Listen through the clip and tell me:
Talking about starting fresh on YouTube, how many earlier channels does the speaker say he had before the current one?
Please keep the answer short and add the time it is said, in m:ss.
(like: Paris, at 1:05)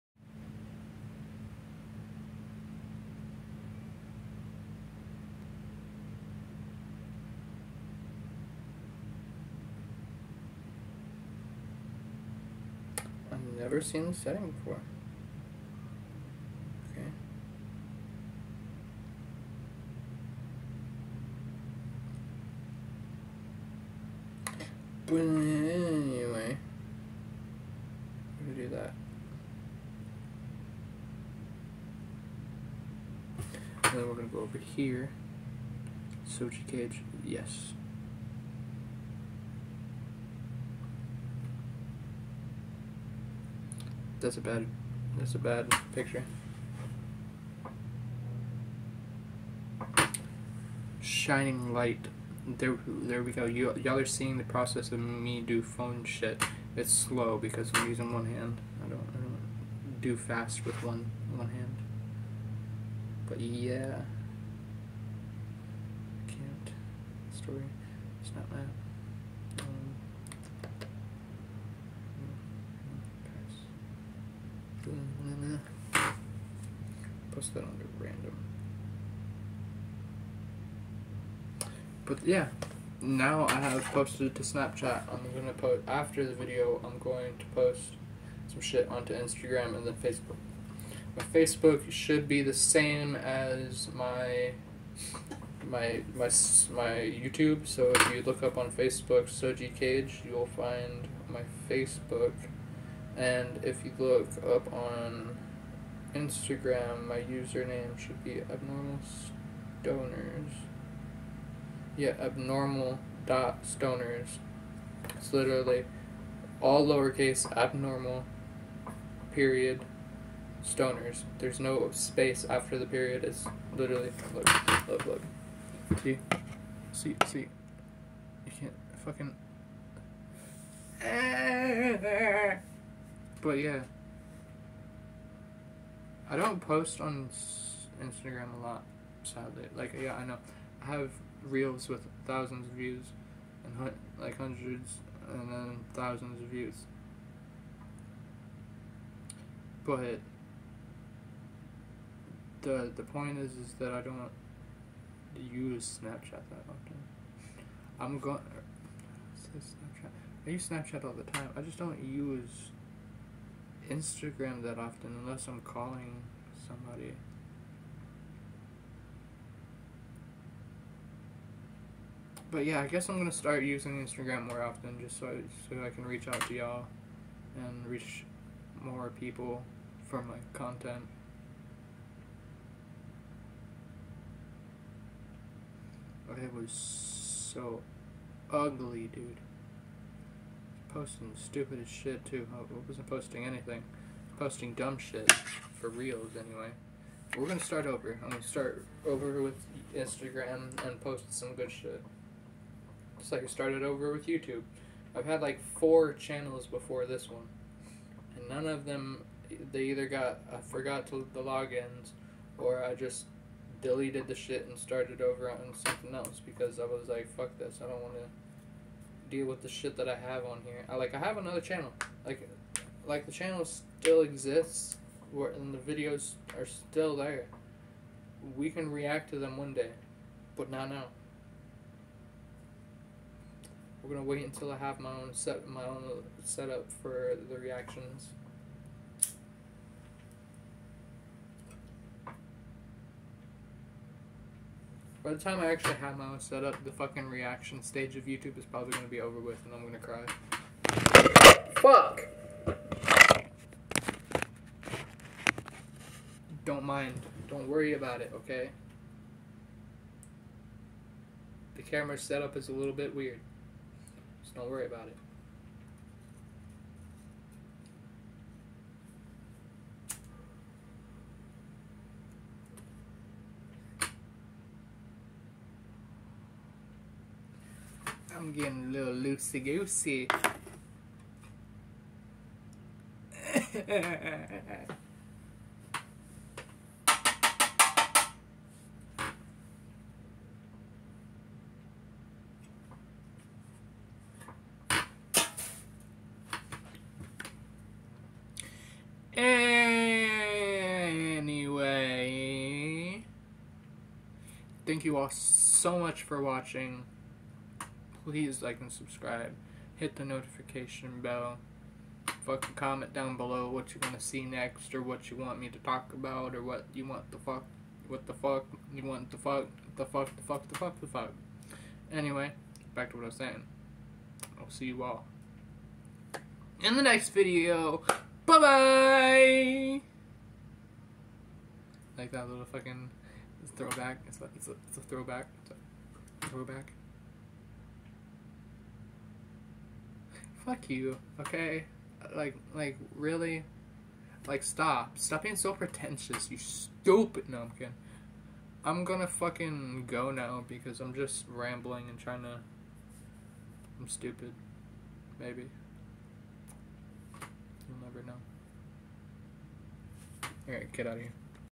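4, at 3:25.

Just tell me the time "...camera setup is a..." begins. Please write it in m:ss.
4:21.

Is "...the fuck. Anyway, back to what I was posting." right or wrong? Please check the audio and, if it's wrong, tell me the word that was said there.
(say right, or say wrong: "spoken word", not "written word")
wrong: "saying", not "posting".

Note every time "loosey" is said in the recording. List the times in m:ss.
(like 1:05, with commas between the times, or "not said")
4:39.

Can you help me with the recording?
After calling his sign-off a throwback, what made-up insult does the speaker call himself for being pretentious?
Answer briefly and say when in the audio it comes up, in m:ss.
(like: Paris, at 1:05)
numpkin, at 5:47.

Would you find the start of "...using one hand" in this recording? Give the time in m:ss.
0:57.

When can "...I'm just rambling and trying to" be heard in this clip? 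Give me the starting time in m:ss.
5:50.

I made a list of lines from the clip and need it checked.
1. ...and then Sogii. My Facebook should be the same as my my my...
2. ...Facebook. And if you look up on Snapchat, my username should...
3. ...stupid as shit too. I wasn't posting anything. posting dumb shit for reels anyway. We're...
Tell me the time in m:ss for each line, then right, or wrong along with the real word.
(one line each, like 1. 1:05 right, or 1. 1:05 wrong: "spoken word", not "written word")
1. 1:29 wrong: "Facebook", not "Sogii"
2. 1:41 wrong: "Instagram", not "Snapchat"
3. 3:11 right.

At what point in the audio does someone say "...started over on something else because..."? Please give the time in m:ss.
3:34.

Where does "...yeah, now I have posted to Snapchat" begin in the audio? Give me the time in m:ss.
1:22.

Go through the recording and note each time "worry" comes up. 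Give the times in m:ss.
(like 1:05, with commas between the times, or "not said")
4:17, 4:24.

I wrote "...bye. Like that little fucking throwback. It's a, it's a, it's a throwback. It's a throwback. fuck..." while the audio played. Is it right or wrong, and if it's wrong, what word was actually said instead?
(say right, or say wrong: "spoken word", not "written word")
right.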